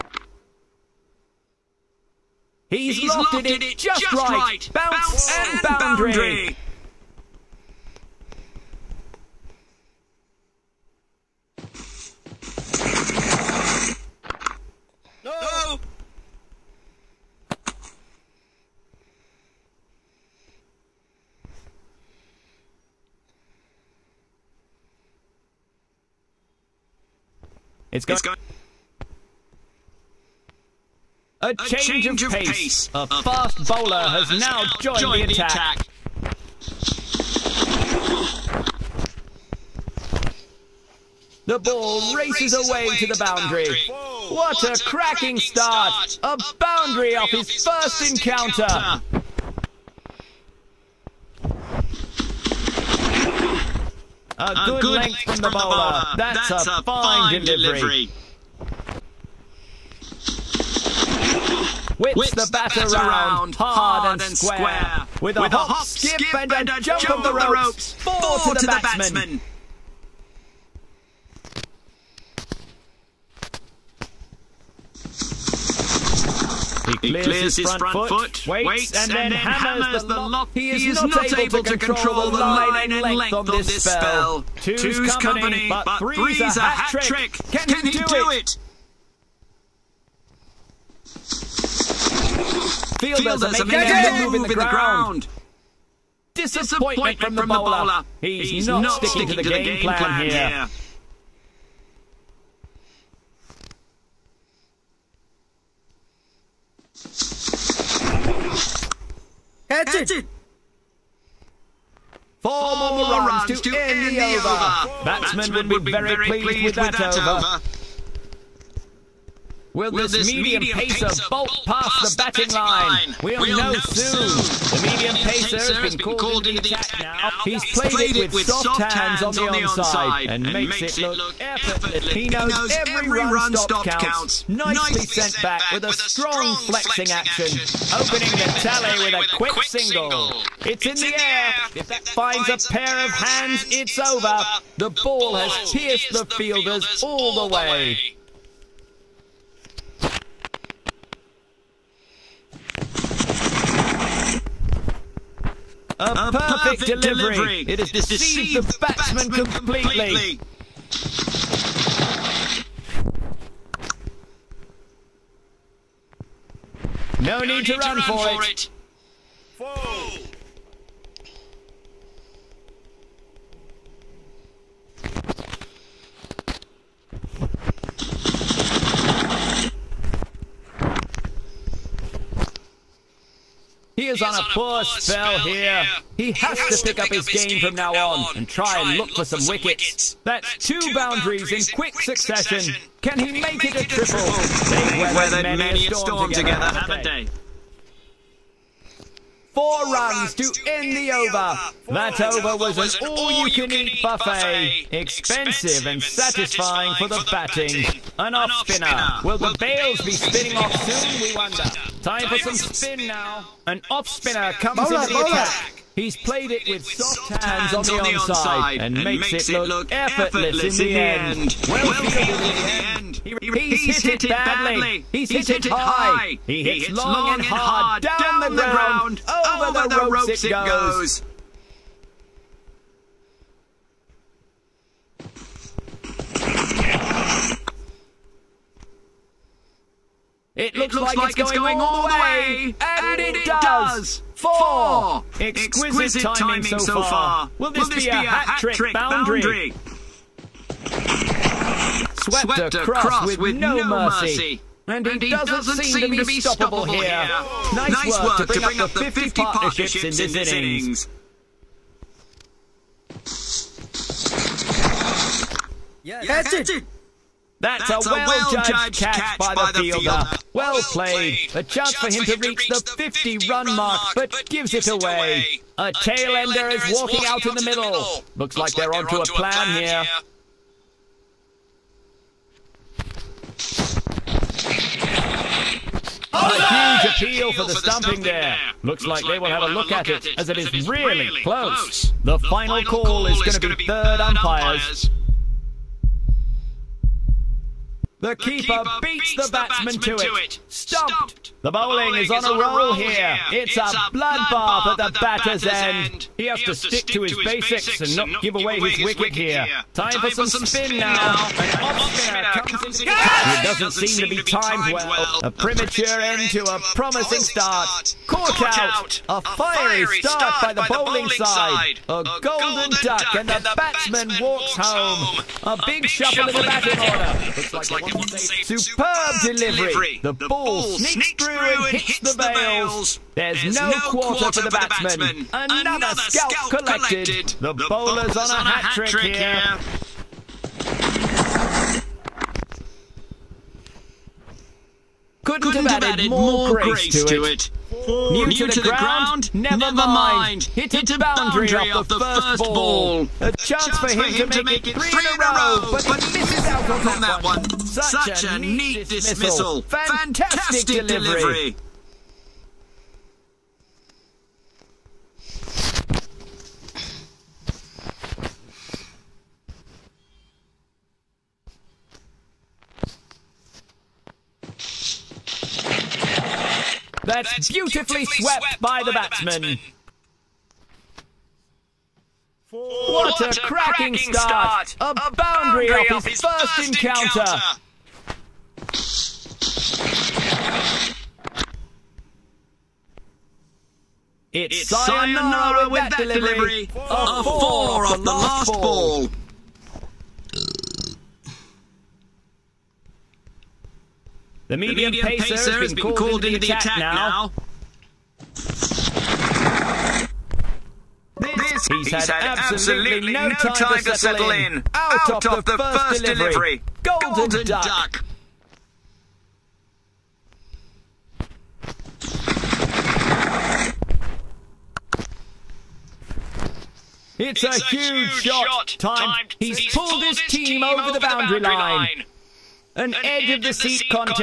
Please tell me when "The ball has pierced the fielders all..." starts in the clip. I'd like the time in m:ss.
2:24.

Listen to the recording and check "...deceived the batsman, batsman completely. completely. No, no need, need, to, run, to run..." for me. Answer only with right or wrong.
right.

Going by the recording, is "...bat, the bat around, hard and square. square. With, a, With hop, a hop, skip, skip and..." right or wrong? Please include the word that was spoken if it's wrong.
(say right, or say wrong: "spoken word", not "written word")
right.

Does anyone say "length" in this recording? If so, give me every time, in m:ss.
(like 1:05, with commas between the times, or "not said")
0:54, 1:23.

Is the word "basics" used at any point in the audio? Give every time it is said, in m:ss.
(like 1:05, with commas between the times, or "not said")
5:07.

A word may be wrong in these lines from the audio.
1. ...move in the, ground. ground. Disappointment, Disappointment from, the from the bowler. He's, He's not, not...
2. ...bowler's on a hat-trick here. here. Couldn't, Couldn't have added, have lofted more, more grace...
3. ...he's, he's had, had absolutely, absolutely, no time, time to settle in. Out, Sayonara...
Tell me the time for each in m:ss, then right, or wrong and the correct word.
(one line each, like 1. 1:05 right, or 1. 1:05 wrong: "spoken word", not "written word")
1. 1:34 right
2. 5:37 wrong: "added", not "lofted"
3. 6:51 wrong: "Out", not "Sayonara".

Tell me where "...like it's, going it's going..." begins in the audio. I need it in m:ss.
4:01.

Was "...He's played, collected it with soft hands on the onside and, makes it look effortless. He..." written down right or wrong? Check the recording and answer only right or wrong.
wrong.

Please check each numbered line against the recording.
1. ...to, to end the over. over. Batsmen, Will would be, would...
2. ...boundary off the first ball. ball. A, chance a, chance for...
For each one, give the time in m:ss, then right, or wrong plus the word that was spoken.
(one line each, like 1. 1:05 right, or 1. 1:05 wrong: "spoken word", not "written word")
1. 1:53 wrong: "Batsmen", not "Will"
2. 5:51 right.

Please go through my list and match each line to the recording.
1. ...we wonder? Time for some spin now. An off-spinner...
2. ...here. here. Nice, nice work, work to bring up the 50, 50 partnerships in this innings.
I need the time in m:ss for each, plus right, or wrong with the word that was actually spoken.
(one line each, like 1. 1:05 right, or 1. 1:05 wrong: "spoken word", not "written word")
1. 3:31 right
2. 4:16 right.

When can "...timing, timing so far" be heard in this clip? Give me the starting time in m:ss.
4:06.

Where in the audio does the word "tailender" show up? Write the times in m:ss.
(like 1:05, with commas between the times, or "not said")
4:35.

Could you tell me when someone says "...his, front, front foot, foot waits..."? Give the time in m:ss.
1:17.